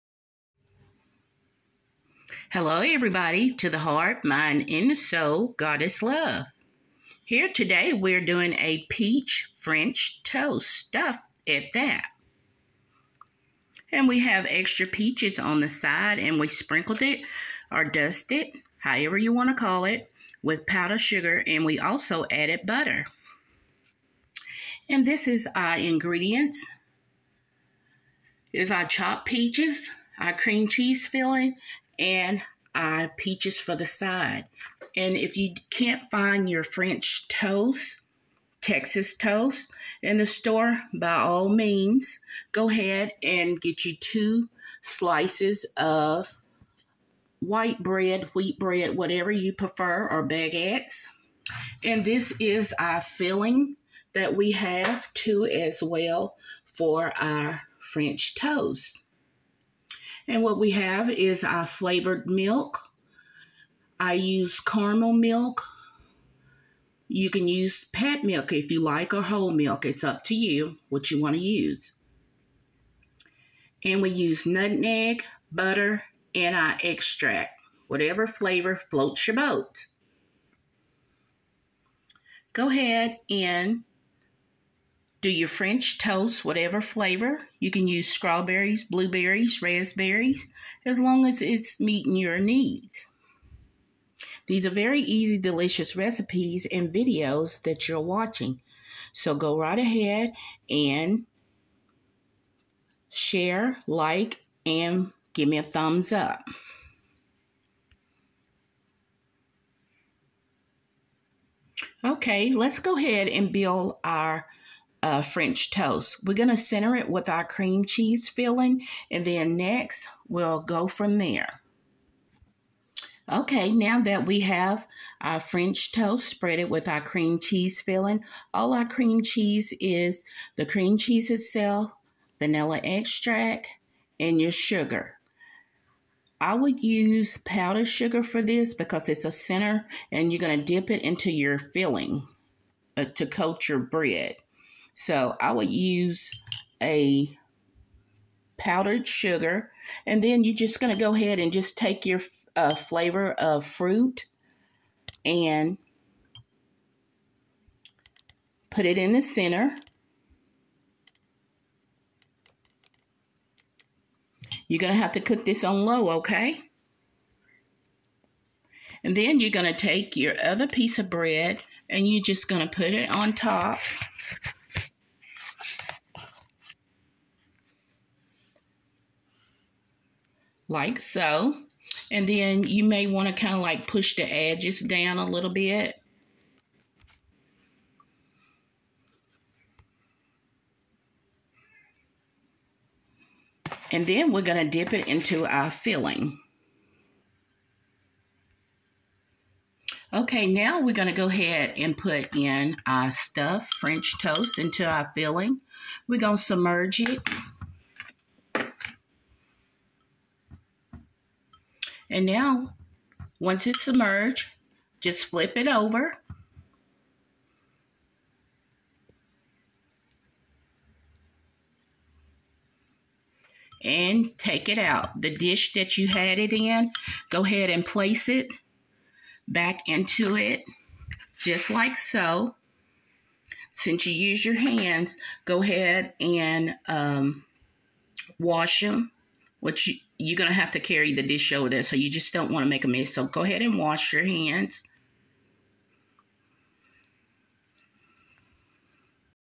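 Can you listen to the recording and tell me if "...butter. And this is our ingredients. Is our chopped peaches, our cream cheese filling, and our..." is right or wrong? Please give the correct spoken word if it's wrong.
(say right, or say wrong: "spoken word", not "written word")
right.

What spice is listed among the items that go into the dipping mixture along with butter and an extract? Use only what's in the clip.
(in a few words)
Nutmeg.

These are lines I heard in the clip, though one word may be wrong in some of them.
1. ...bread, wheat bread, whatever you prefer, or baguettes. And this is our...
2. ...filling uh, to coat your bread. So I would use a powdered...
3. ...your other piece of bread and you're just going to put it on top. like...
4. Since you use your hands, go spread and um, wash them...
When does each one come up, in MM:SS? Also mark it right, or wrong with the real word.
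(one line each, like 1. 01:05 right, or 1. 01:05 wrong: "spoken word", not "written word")
1. 00:47 right
2. 02:21 right
3. 02:50 right
4. 03:53 wrong: "ahead", not "spread".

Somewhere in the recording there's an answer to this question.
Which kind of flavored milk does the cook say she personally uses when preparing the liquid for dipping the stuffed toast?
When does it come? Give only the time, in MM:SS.
01:04.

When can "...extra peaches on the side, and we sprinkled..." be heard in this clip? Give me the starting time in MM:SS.
00:14.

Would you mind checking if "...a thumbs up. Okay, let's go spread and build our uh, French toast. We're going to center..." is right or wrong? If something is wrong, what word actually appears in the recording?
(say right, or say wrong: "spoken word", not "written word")
wrong: "ahead", not "spread".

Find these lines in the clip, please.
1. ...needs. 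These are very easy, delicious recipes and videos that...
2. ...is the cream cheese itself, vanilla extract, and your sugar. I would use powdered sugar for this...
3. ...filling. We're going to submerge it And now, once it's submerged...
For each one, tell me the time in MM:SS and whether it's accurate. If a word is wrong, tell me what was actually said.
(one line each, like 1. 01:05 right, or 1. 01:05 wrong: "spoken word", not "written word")
1. 01:32 right
2. 02:09 right
3. 03:25 right.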